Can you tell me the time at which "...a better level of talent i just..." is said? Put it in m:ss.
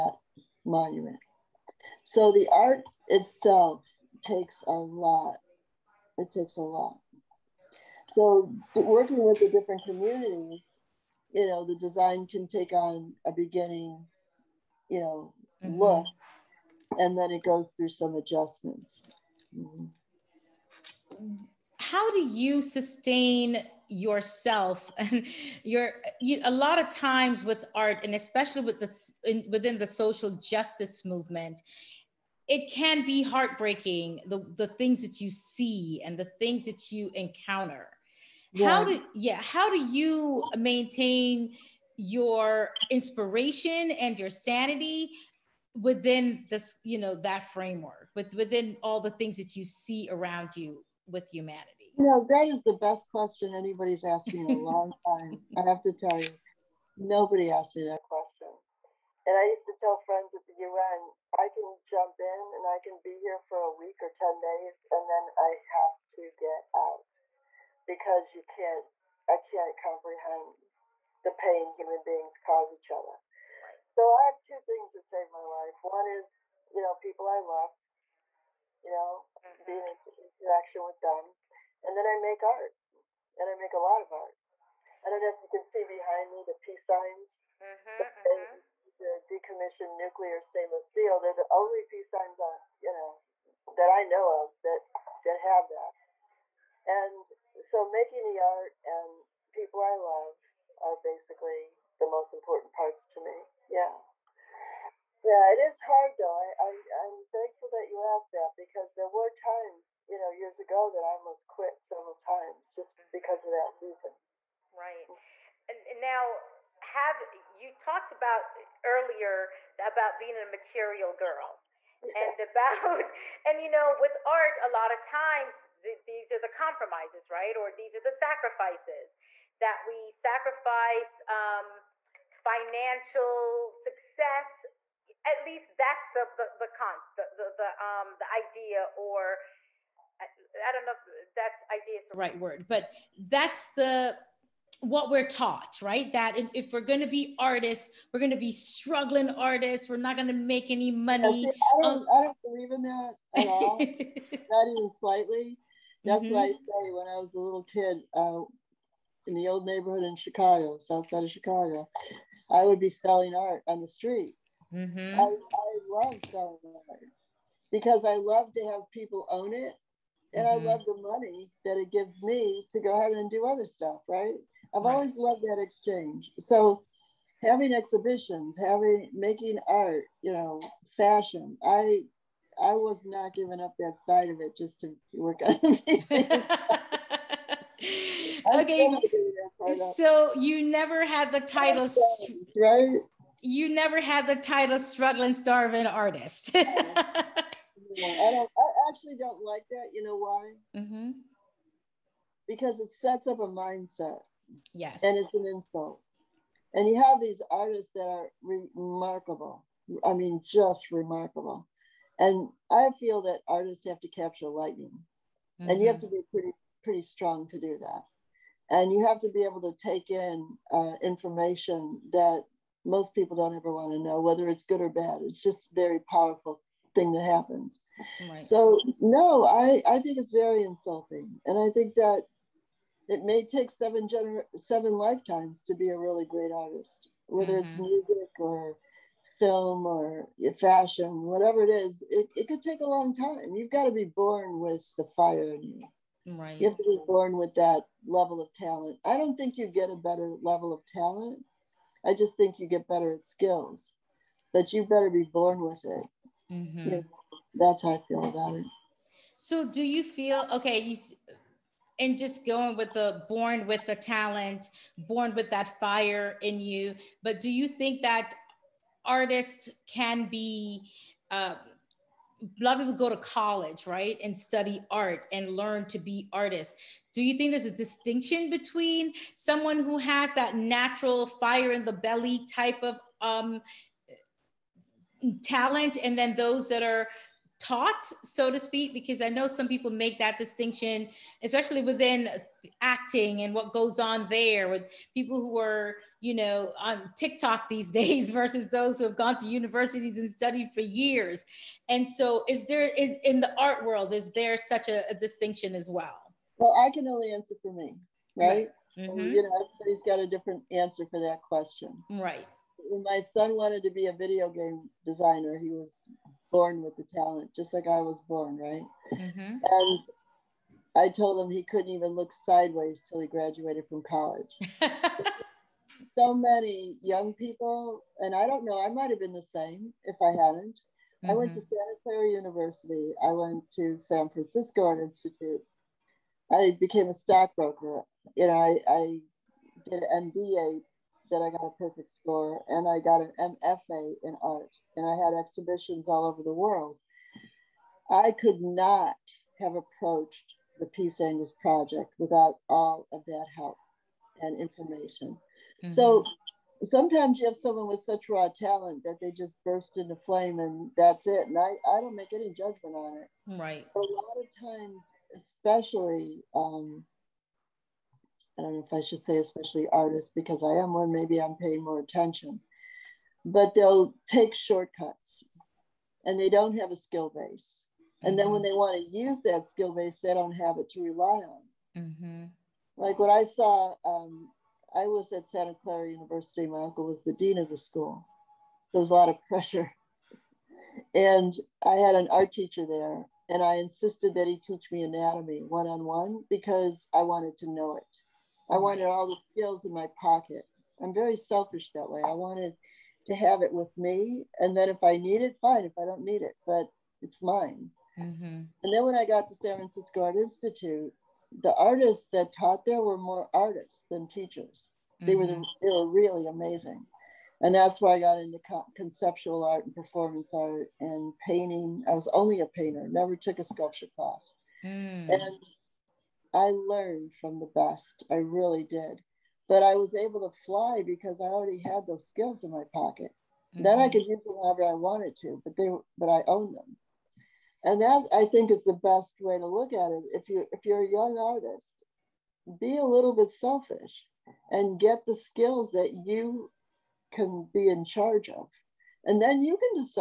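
4:09.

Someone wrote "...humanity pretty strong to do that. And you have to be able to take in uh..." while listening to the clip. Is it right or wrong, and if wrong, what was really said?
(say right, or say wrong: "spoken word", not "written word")
wrong: "pretty", not "humanity".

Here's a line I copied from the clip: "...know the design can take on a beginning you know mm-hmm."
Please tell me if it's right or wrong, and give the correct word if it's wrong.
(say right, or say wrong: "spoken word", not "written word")
right.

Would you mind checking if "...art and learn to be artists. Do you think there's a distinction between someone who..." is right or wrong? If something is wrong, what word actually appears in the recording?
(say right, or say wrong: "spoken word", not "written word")
right.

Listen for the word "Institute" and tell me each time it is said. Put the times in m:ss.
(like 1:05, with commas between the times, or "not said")
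5:35, 6:50.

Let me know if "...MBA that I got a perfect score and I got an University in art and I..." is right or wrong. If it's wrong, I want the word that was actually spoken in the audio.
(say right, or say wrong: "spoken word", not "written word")
wrong: "MFA", not "University".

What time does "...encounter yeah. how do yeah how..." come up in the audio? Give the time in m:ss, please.
0:37.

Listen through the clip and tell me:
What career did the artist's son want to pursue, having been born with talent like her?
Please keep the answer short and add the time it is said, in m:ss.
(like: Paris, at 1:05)
Video game designer, at 5:14.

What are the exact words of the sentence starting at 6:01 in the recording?
And I, I don't make any judgment on it.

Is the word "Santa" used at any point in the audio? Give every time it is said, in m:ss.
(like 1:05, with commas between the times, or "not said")
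5:31, 6:25.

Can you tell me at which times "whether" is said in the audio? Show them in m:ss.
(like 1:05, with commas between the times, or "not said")
3:44, 3:57.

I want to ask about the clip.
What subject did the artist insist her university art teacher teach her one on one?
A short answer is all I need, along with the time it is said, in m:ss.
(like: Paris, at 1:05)
Anatomy, at 6:35.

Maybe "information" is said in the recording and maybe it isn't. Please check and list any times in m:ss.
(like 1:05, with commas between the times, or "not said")
3:41, 5:54.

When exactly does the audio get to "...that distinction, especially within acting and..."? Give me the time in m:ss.
4:50.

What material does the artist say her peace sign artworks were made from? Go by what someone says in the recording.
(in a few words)
decommissioned nuclear stainless steel.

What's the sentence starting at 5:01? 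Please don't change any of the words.
And so, is there in, in the art world, is there such a, a, distinction as well?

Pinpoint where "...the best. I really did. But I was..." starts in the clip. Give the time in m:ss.
7:07.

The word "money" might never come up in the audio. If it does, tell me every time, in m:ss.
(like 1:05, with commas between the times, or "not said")
2:30, 2:50.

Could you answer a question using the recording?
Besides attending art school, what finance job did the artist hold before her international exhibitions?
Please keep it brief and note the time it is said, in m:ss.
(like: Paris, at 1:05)
Stockbroker, at 5:37.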